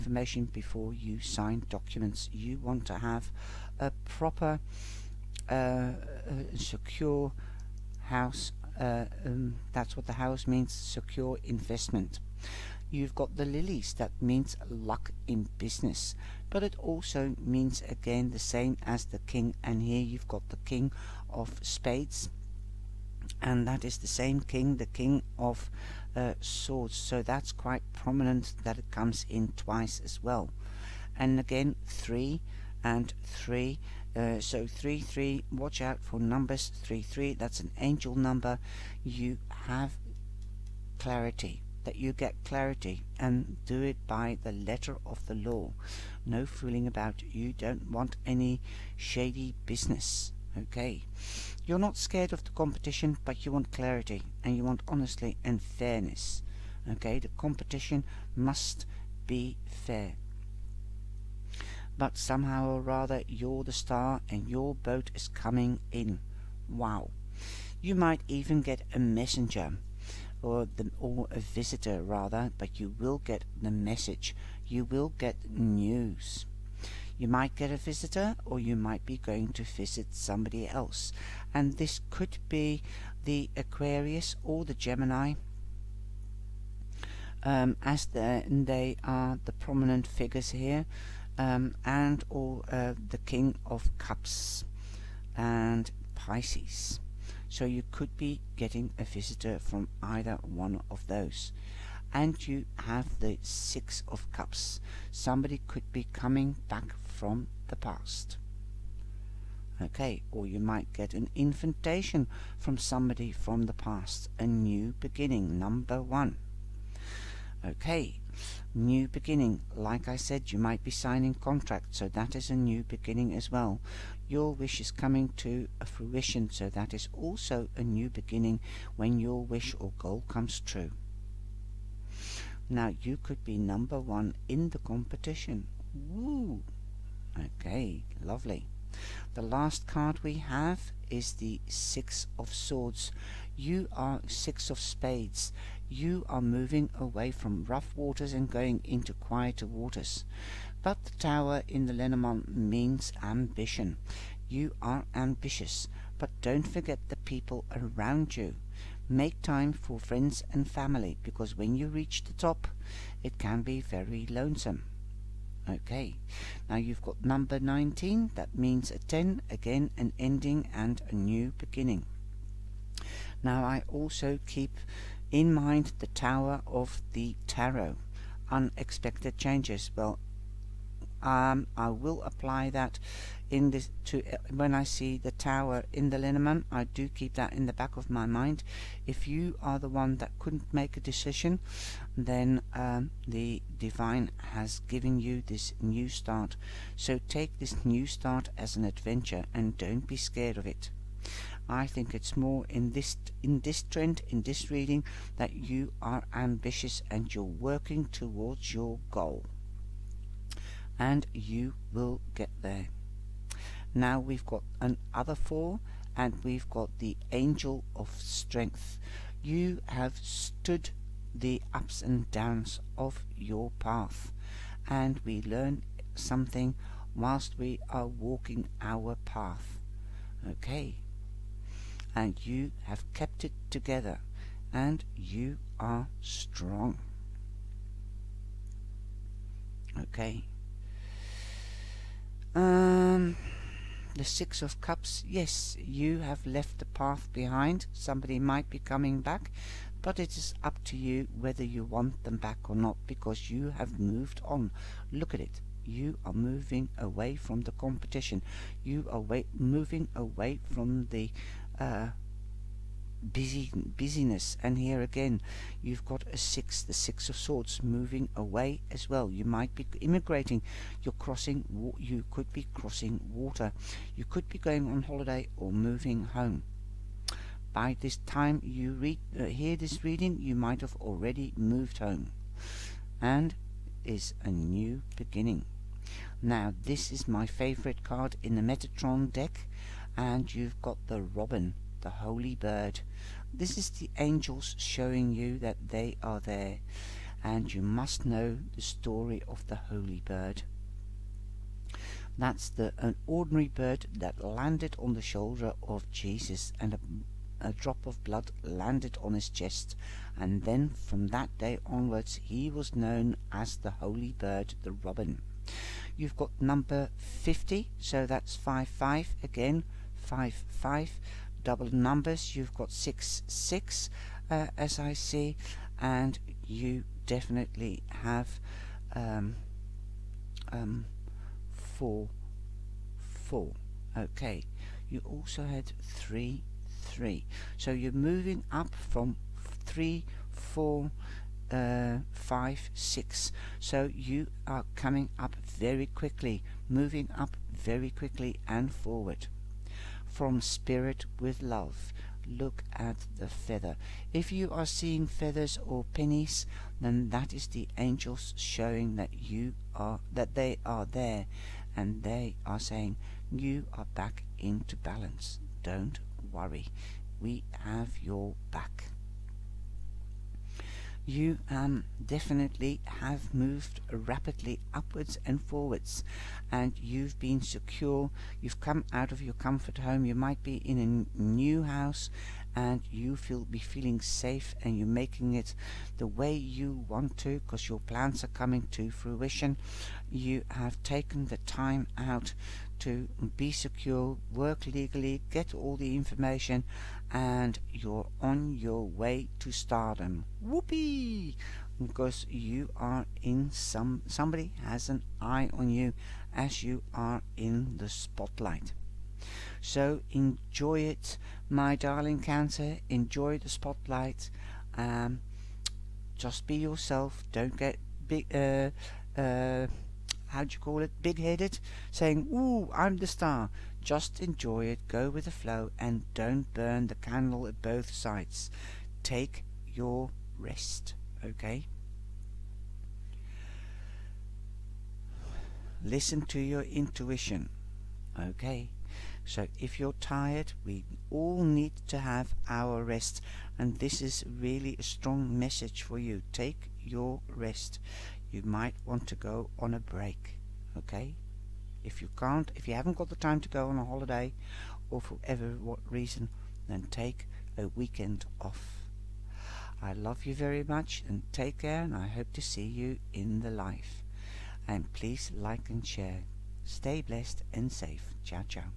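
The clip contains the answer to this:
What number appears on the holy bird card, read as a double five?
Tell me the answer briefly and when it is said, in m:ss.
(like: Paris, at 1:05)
50, at 5:16.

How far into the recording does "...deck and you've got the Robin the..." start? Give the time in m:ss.
4:49.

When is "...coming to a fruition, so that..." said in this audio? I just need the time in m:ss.
2:04.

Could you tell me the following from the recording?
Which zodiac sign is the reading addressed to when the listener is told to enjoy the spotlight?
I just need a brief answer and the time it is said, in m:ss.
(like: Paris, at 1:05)
Cancer, at 6:52.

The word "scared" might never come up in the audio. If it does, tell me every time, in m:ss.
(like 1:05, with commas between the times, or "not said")
0:51, 3:20.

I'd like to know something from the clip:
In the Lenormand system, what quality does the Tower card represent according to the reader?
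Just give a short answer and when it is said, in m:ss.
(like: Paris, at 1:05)
Ambition, at 2:32.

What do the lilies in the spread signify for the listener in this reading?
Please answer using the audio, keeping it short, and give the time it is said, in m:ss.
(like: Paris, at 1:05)
Luck in business, at 0:14.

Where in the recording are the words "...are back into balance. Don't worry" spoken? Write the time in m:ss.
6:03.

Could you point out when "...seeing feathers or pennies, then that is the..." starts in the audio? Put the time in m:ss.
5:54.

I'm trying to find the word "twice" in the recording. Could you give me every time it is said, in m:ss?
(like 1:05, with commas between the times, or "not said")
0:29.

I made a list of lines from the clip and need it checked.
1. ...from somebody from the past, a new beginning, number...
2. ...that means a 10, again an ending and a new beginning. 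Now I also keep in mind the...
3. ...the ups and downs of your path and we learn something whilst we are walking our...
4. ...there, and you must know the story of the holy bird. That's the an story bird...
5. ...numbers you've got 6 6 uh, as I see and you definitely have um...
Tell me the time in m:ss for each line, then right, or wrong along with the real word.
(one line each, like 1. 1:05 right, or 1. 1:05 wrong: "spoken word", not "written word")
1. 1:52 right
2. 2:48 right
3. 3:41 right
4. 4:56 wrong: "ordinary", not "story"
5. 5:21 right.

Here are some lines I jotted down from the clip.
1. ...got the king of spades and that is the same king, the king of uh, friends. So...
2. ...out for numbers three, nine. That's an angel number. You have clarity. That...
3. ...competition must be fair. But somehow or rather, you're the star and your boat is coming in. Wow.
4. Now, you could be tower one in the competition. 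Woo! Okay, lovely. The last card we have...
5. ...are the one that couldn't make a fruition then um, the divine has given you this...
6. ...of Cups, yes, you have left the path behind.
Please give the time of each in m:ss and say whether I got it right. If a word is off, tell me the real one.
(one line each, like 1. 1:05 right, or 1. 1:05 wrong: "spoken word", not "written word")
1. 0:20 wrong: "swords", not "friends"
2. 0:35 wrong: "three", not "nine"
3. 0:57 right
4. 2:12 wrong: "number", not "tower"
5. 3:09 wrong: "decision", not "fruition"
6. 4:04 right.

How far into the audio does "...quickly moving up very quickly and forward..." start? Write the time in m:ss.
5:46.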